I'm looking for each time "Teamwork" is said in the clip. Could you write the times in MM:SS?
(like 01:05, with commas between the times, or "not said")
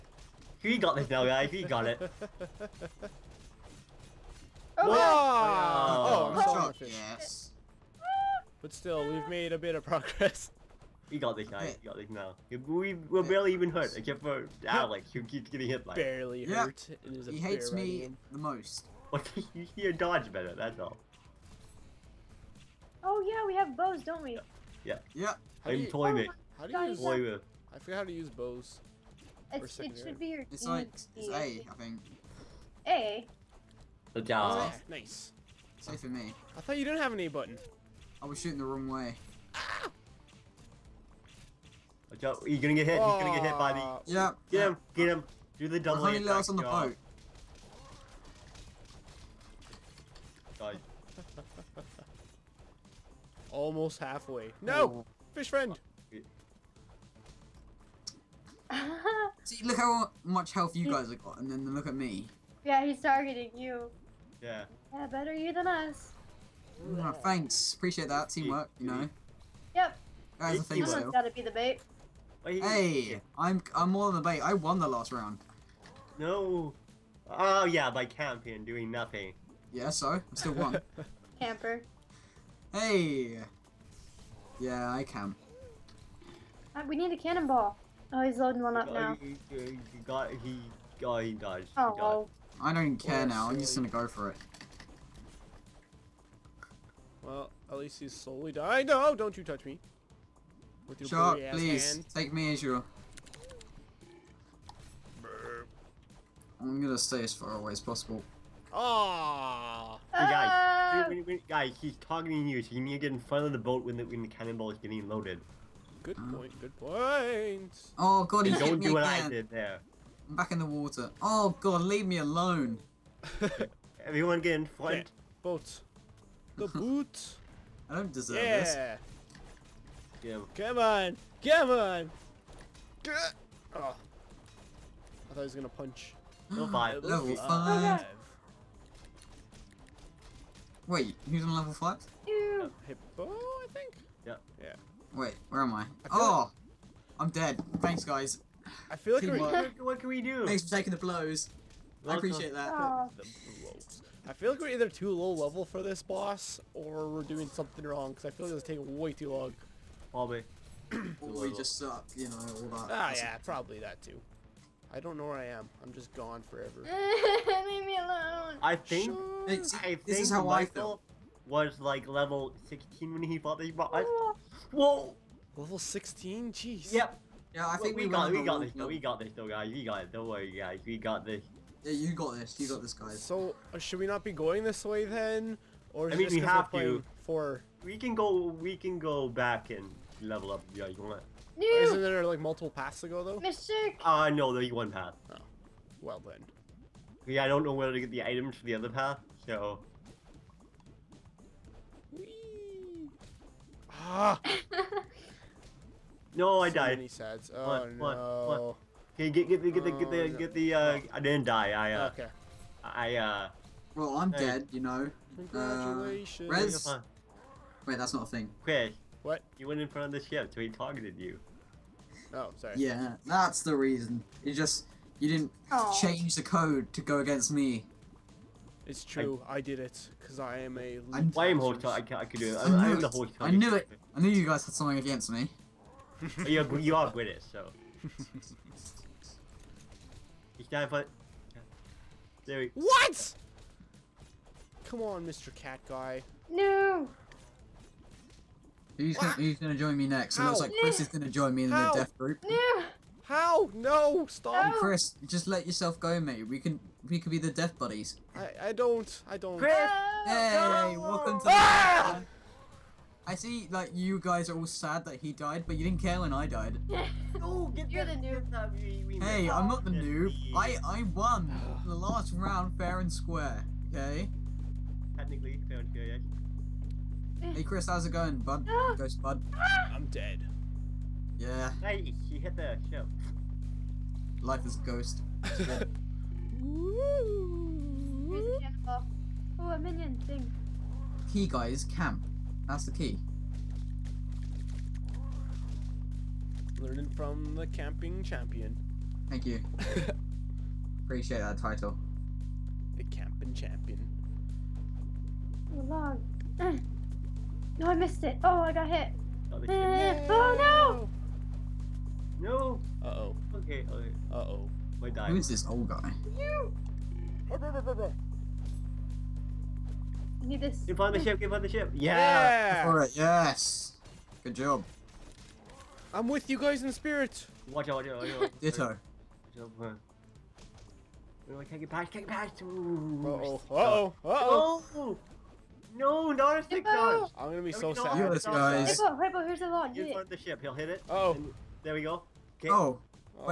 01:08.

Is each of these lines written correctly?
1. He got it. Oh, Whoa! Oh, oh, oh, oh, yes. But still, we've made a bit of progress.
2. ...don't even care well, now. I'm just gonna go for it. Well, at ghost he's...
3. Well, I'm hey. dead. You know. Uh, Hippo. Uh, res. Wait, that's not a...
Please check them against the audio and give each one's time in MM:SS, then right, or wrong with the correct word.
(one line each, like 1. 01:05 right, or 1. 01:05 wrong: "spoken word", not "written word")
1. 00:01 right
2. 01:32 wrong: "least", not "ghost"
3. 03:33 wrong: "Congratulations", not "Hippo".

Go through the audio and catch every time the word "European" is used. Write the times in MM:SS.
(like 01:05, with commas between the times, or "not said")
not said.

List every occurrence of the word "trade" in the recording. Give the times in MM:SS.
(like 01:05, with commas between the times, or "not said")
not said.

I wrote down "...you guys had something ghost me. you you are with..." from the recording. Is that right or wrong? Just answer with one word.
wrong.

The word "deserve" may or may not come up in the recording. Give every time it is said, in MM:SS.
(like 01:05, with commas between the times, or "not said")
02:08.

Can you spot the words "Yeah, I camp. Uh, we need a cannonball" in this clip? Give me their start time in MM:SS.
01:24.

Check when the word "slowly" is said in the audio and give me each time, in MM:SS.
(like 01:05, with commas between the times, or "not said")
01:38.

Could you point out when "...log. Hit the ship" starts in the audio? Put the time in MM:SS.
05:39.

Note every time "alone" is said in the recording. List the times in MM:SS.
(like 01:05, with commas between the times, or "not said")
02:02, 02:47.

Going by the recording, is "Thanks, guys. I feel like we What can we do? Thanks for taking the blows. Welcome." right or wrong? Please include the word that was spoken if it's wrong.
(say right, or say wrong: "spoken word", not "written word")
right.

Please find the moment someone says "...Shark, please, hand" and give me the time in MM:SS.
01:41.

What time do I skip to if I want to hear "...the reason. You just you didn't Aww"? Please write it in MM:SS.
03:43.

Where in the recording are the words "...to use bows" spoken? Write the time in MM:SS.
00:28.